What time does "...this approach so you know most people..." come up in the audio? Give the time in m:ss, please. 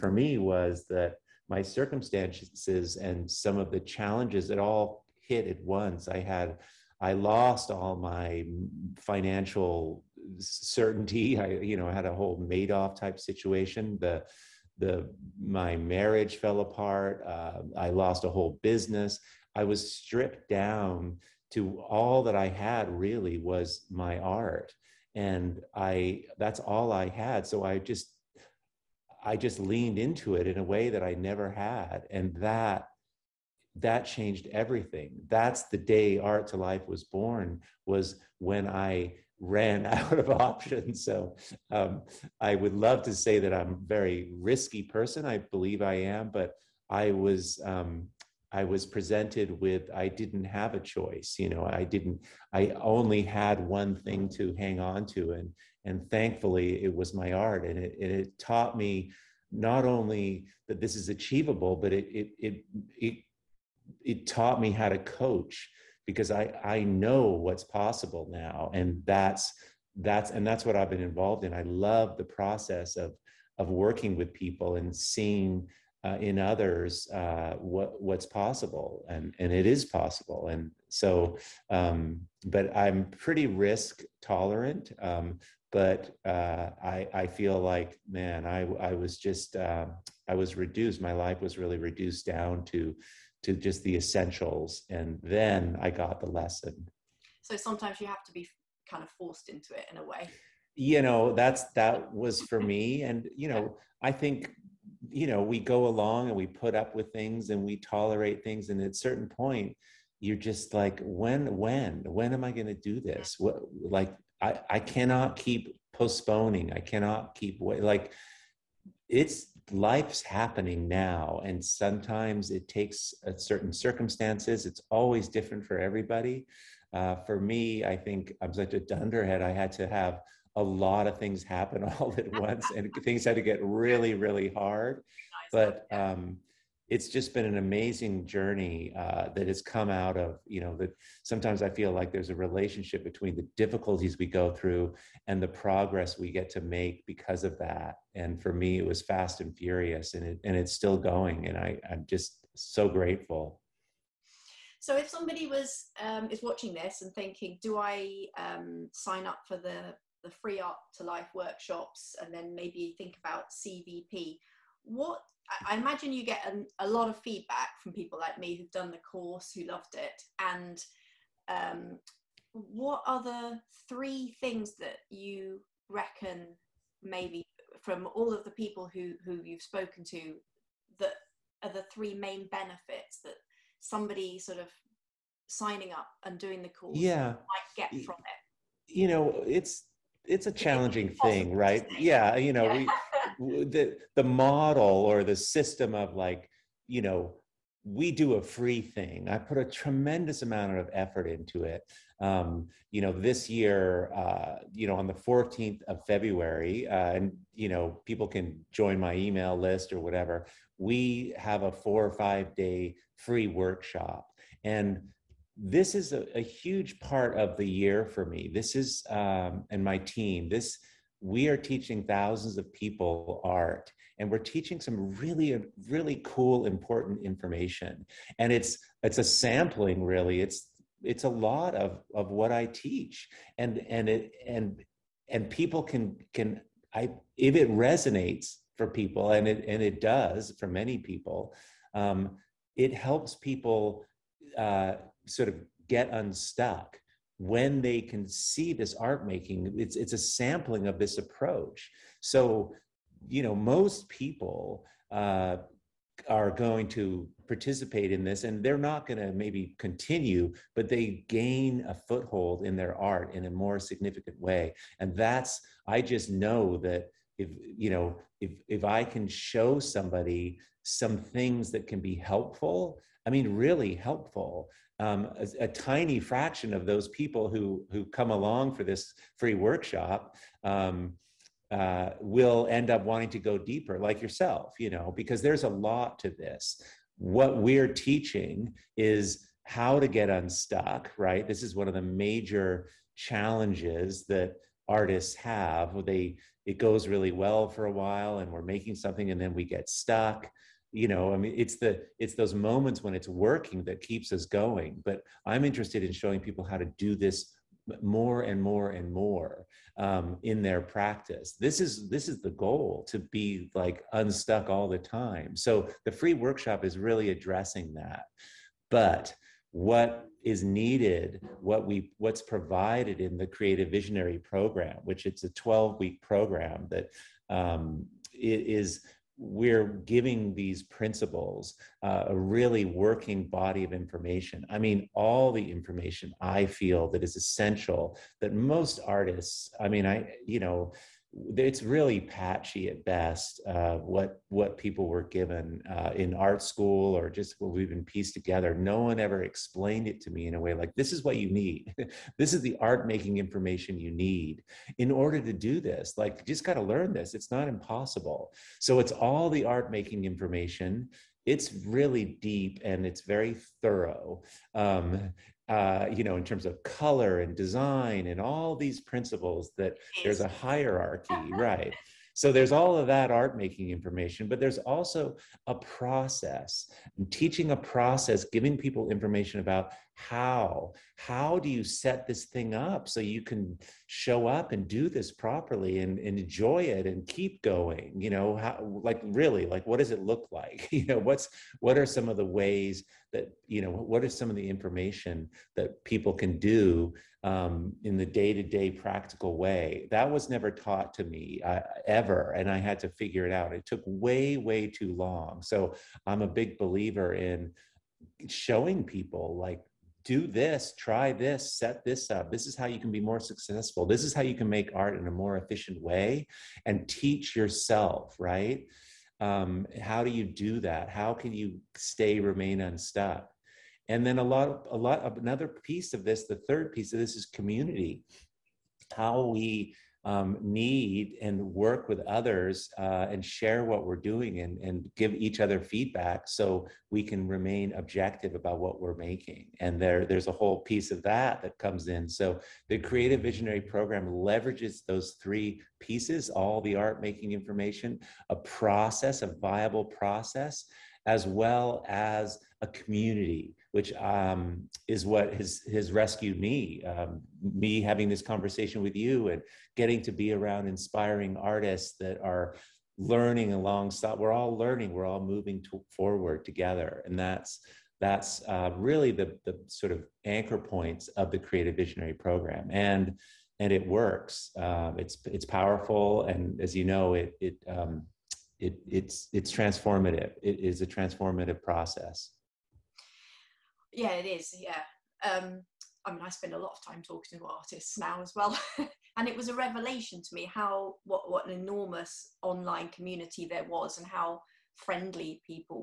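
4:10.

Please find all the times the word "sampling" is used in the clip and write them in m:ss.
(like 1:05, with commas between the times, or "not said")
3:49, 4:10.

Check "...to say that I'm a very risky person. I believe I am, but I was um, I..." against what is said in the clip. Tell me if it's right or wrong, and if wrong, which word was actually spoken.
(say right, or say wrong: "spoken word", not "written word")
right.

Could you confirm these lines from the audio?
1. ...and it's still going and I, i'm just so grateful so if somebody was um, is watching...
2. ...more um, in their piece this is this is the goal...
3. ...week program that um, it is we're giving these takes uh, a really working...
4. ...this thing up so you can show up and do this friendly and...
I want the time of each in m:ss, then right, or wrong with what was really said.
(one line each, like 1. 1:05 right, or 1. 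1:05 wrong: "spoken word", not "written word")
1. 2:30 right
2. 5:09 wrong: "practice", not "piece"
3. 5:25 wrong: "principles", not "takes"
4. 6:22 wrong: "properly", not "friendly".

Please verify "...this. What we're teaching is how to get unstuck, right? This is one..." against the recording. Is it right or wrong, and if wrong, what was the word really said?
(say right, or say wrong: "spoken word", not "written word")
right.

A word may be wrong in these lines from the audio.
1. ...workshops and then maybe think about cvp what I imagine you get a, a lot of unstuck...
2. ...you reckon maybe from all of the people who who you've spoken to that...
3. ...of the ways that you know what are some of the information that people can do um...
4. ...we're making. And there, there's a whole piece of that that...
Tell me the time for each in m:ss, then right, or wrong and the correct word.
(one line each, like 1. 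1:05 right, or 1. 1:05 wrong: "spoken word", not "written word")
1. 2:41 wrong: "feedback", not "unstuck"
2. 2:55 right
3. 6:32 right
4. 7:19 right.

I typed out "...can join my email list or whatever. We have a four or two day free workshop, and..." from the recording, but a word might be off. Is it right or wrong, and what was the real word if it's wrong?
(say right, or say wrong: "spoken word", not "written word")
wrong: "five", not "two".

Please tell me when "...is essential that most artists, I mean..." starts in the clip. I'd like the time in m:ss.
5:37.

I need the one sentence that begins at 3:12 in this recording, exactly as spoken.
we the the model or the system of like you know we do a free thing.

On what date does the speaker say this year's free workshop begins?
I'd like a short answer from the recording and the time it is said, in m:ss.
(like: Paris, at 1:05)
14th of February, at 3:25.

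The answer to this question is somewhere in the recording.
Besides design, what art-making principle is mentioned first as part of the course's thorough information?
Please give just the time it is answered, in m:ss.
6:06.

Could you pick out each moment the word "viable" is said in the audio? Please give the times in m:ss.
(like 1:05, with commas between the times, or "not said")
7:29.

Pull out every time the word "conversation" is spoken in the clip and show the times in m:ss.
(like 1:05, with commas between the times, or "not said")
7:38.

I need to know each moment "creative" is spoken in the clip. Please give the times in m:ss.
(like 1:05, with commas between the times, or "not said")
5:23, 7:22, 7:51.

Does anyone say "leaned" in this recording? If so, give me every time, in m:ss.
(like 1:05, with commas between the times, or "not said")
0:29.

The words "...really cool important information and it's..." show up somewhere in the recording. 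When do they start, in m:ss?
3:45.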